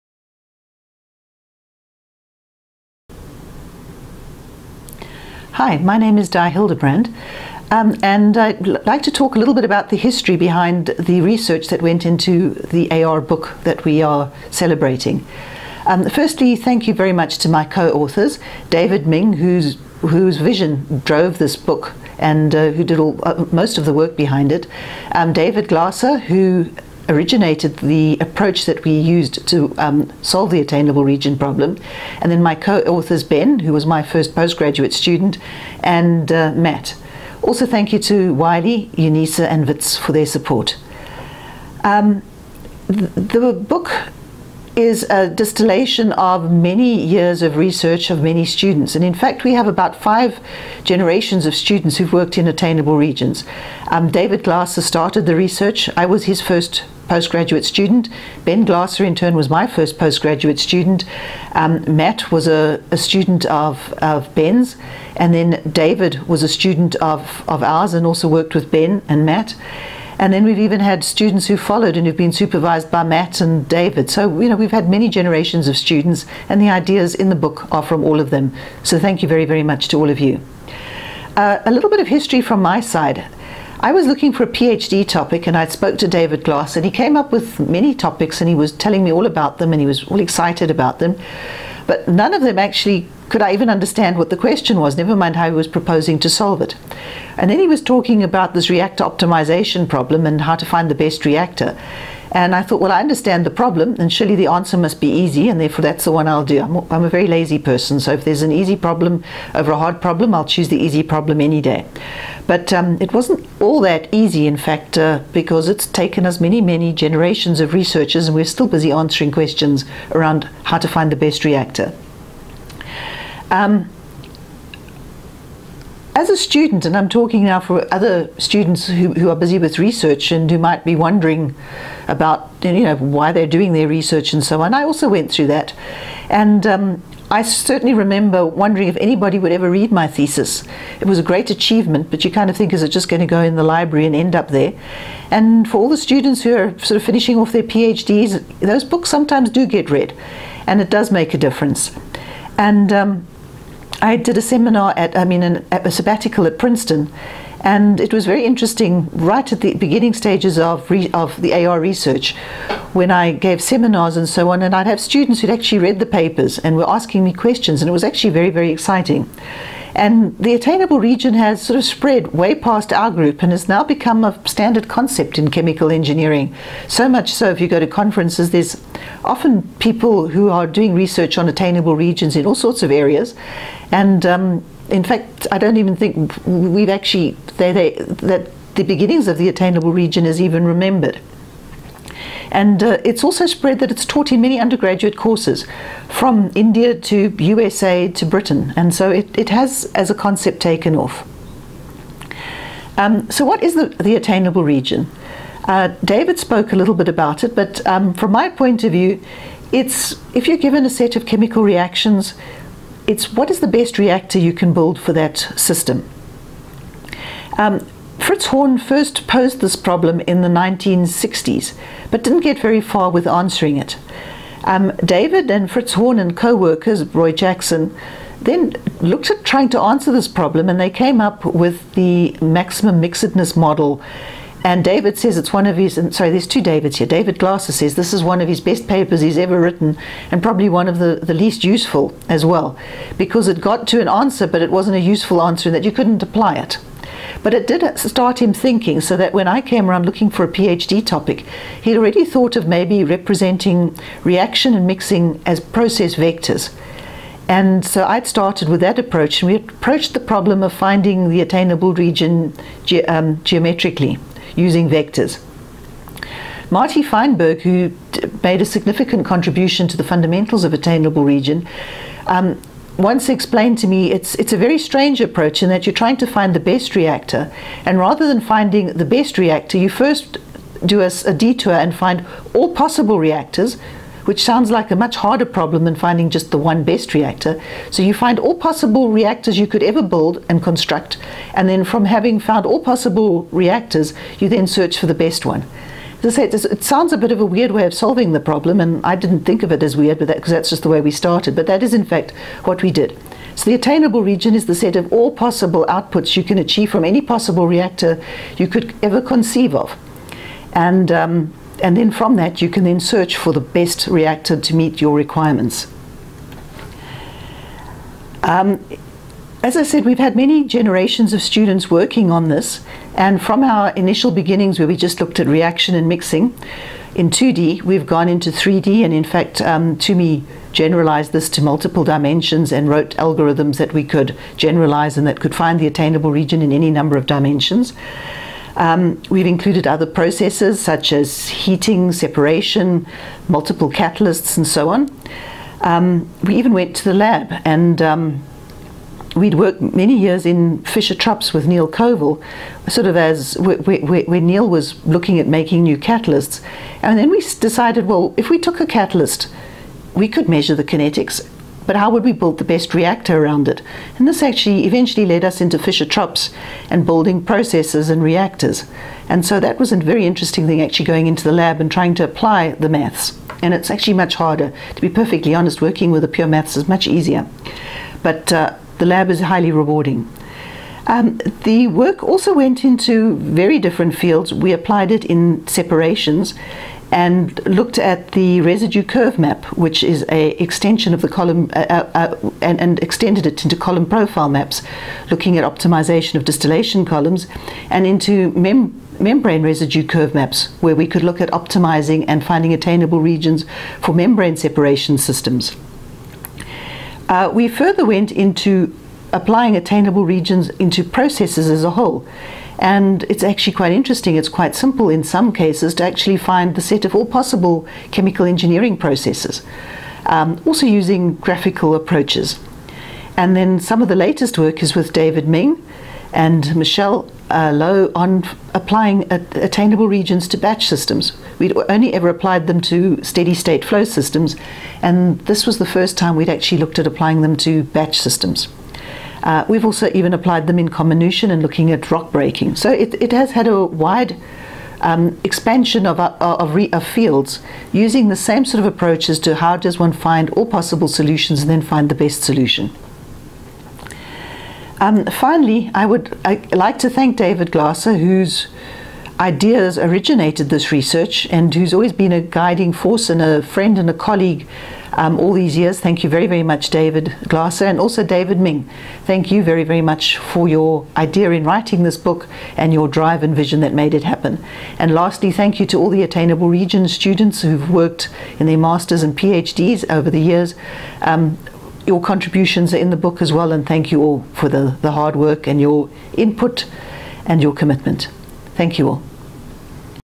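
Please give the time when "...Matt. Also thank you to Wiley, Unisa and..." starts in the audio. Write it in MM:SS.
00:36.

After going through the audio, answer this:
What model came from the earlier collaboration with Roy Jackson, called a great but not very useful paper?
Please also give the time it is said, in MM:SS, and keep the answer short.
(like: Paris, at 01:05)
maximum mixedness model, at 03:52.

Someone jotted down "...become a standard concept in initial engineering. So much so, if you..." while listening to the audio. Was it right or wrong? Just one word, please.
wrong.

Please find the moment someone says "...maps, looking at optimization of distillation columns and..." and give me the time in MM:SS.
06:34.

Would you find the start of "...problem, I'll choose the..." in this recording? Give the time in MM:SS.
01:50.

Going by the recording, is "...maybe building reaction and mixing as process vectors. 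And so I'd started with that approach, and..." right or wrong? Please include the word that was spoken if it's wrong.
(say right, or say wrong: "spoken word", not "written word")
wrong: "representing", not "building".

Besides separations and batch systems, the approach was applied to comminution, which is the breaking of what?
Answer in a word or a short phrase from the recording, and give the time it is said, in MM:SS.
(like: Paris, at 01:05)
rock breaking, at 07:22.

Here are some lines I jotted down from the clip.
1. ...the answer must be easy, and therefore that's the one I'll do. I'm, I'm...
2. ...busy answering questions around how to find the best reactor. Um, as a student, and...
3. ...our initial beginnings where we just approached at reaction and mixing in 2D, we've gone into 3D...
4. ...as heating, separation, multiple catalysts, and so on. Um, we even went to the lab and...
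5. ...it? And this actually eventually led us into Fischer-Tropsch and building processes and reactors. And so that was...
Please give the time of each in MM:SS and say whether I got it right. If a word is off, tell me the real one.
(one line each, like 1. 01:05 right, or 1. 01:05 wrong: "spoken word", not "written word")
1. 01:44 right
2. 01:58 right
3. 05:23 wrong: "looked", not "approached"
4. 05:41 right
5. 06:03 right.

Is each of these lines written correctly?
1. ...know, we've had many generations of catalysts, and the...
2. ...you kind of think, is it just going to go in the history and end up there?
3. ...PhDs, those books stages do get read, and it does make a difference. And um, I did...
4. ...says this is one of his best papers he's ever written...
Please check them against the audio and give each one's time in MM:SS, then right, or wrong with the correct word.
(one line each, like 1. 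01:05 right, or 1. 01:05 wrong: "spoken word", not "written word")
1. 01:14 wrong: "students", not "catalysts"
2. 02:22 wrong: "library", not "history"
3. 02:27 wrong: "sometimes", not "stages"
4. 03:57 right.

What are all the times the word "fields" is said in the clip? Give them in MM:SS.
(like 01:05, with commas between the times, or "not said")
06:24, 07:27.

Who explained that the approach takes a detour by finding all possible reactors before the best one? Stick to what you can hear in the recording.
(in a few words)
Marty Feinberg.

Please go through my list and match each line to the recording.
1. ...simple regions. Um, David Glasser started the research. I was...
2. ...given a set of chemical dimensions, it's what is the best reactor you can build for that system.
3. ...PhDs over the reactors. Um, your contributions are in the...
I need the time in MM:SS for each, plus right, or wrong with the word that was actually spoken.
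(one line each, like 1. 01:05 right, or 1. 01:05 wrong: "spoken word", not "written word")
1. 00:52 wrong: "attainable", not "simple"
2. 03:30 wrong: "reactions", not "dimensions"
3. 07:59 wrong: "years", not "reactors".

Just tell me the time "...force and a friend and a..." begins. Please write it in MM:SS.
07:42.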